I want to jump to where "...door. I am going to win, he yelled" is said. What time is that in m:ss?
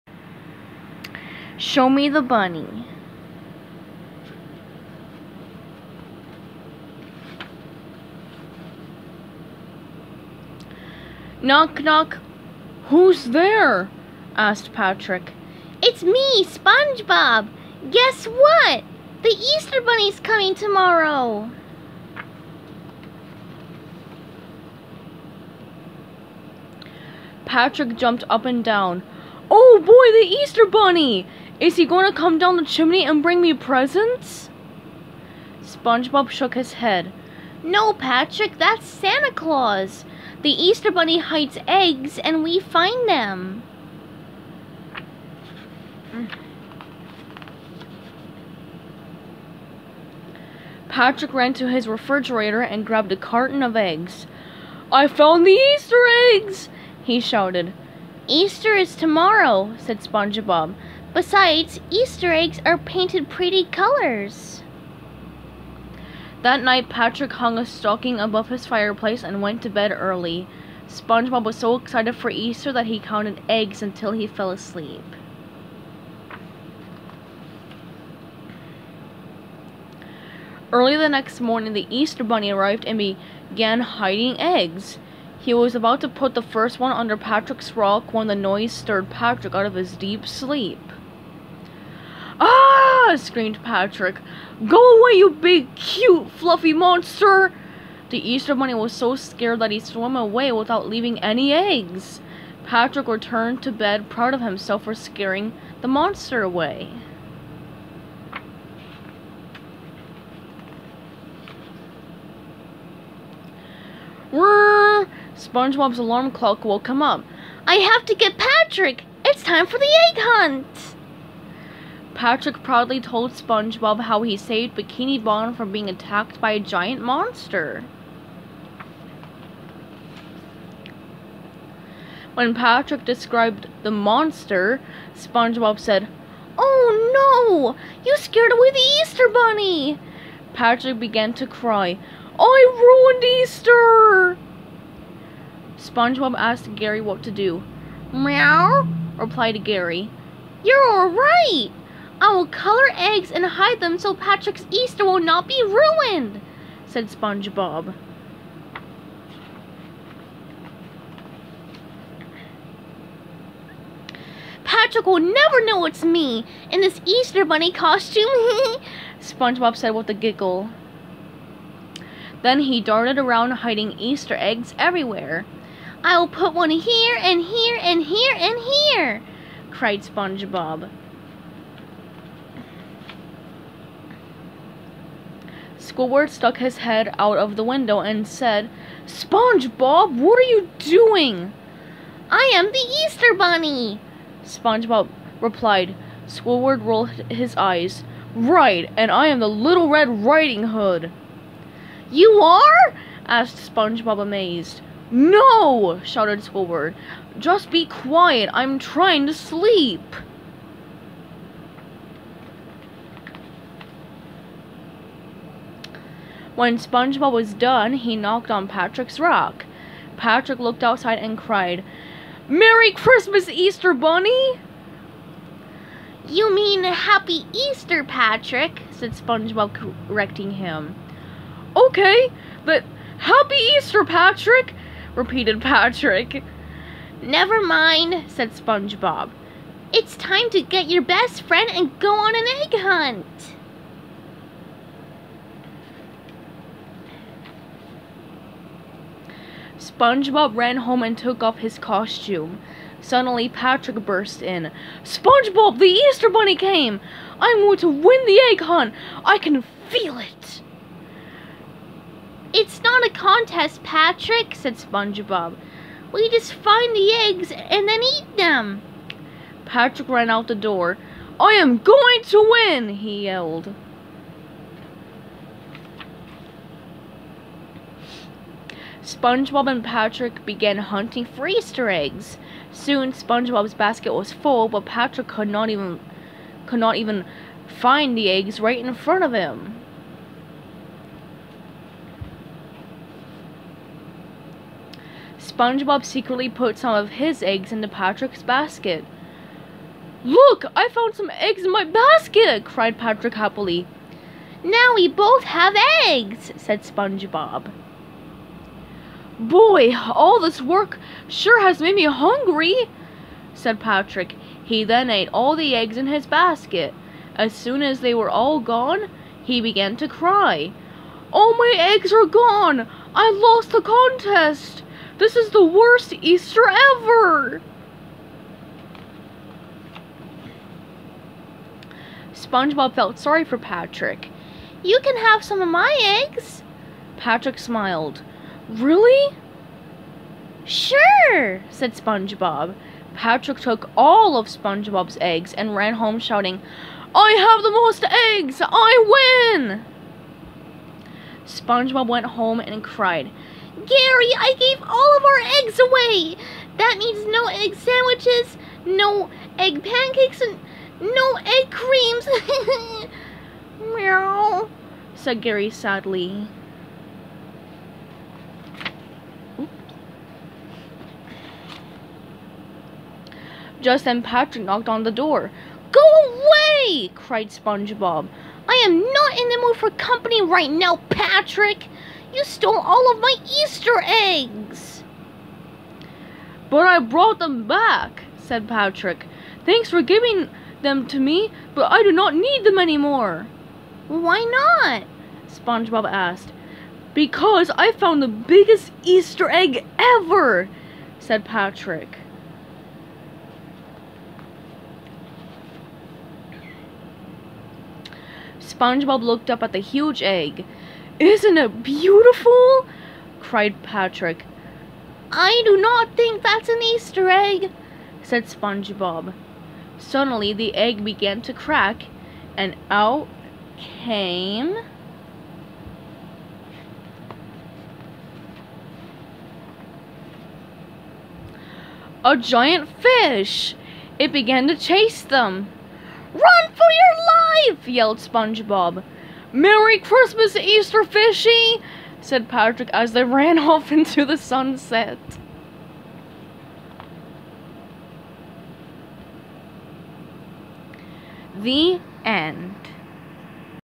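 4:30.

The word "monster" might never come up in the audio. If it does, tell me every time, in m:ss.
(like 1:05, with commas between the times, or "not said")
1:36, 1:45, 2:07, 2:13.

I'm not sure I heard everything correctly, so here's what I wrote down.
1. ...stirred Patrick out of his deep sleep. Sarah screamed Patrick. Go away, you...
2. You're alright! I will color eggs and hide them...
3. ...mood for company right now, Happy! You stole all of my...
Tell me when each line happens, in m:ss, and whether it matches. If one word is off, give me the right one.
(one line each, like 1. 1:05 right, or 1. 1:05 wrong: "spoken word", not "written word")
1. 1:28 right
2. 2:30 right
3. 6:19 wrong: "Patrick", not "Happy".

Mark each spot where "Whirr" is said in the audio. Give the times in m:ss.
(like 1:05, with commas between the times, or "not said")
1:54.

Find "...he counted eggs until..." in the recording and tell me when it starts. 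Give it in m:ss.
1:12.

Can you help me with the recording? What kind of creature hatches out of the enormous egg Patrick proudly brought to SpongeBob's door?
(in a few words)
a giant fish.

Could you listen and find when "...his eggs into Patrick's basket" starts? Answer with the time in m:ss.
4:57.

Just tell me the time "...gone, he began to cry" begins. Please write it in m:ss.
5:18.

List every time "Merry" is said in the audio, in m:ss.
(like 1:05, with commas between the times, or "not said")
3:42, 7:19.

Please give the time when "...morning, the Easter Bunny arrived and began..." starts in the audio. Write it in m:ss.
1:21.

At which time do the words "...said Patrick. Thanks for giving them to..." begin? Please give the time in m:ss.
6:28.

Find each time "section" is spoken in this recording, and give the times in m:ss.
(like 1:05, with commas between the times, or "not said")
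not said.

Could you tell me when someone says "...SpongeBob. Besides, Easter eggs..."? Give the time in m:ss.
1:00.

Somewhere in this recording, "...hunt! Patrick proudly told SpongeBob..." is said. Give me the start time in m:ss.
2:00.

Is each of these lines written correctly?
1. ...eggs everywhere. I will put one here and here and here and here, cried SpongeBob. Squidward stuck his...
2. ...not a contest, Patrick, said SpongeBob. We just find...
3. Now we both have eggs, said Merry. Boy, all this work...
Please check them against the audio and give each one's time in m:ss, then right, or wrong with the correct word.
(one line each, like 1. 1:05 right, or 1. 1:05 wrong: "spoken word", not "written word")
1. 2:54 right
2. 4:22 right
3. 5:04 wrong: "SpongeBob", not "Merry".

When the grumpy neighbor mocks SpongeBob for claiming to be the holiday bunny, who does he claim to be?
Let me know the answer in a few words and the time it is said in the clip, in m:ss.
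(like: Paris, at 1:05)
Little Red Riding Hood, at 3:19.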